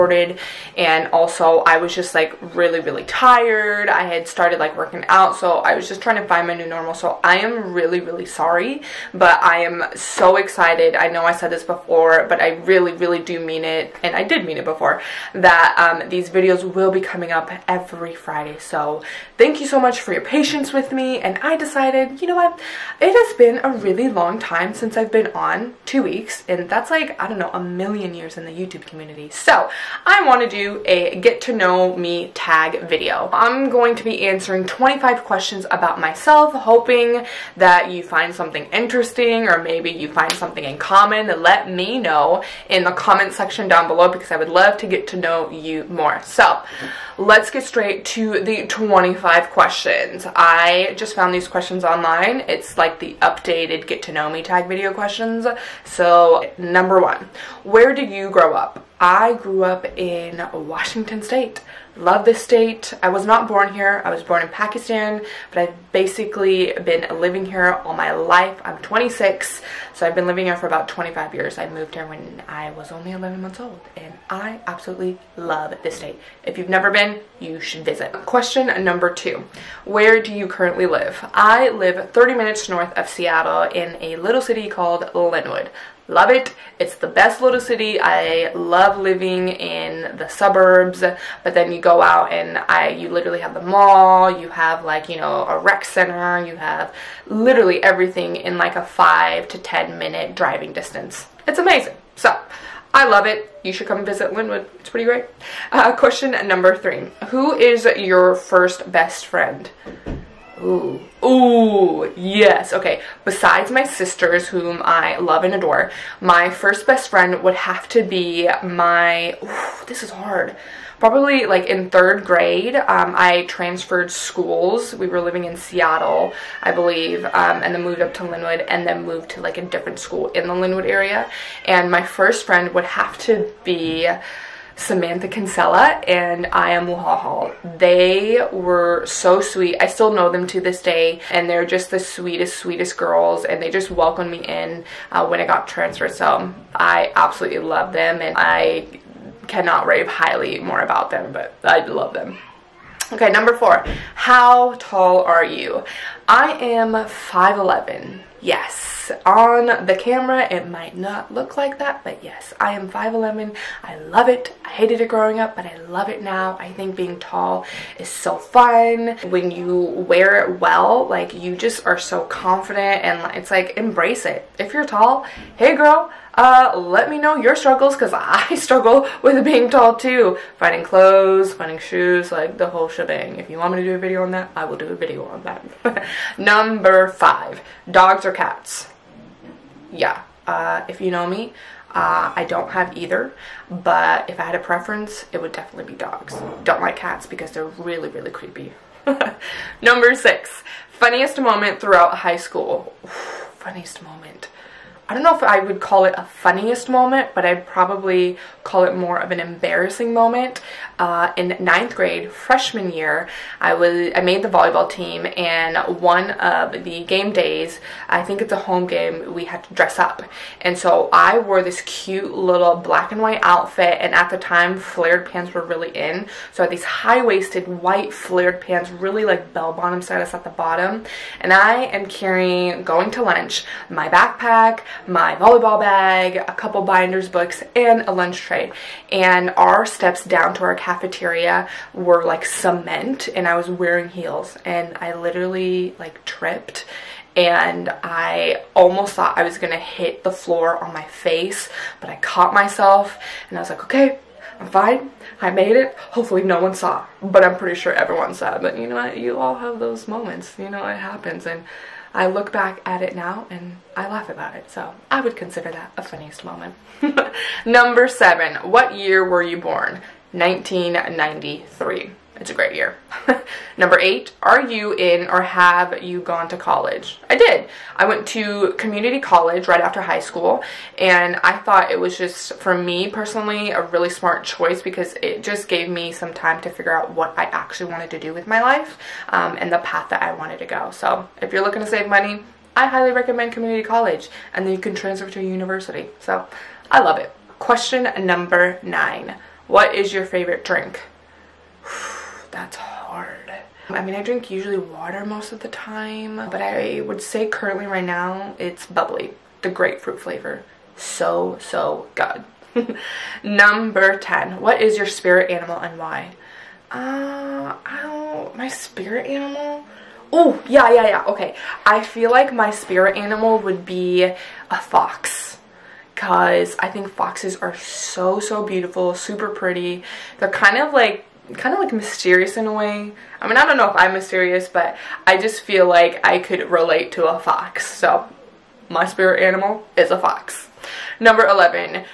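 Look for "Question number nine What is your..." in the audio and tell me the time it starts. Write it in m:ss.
4:57.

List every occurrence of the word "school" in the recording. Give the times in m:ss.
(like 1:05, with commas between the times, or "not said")
2:04, 2:09, 3:22, 4:40.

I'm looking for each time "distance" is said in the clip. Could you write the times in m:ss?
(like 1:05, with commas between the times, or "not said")
1:40.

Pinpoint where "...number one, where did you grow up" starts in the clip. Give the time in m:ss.
0:56.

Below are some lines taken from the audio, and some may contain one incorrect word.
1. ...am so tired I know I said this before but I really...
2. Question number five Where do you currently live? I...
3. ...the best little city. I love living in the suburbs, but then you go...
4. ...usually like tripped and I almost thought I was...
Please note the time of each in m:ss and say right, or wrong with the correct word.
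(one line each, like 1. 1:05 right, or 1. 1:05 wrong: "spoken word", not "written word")
1. 0:09 wrong: "excited", not "tired"
2. 1:18 wrong: "two", not "five"
3. 1:26 right
4. 4:05 wrong: "literally", not "usually".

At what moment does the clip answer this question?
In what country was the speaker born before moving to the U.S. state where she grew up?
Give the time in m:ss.
1:04.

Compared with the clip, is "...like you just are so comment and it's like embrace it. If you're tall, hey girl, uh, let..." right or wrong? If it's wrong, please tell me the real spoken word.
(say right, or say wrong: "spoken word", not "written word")
wrong: "confident", not "comment".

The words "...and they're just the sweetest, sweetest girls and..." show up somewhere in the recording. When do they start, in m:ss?
2:21.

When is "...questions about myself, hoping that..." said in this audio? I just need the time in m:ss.
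0:35.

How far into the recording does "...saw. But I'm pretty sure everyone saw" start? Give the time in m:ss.
4:16.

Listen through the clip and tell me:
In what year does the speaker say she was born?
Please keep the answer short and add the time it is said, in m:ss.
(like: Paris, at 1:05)
1993, at 4:30.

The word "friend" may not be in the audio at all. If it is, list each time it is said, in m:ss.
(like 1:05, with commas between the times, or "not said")
1:49, 1:57, 2:12.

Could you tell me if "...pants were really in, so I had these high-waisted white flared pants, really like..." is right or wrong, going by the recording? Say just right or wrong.
right.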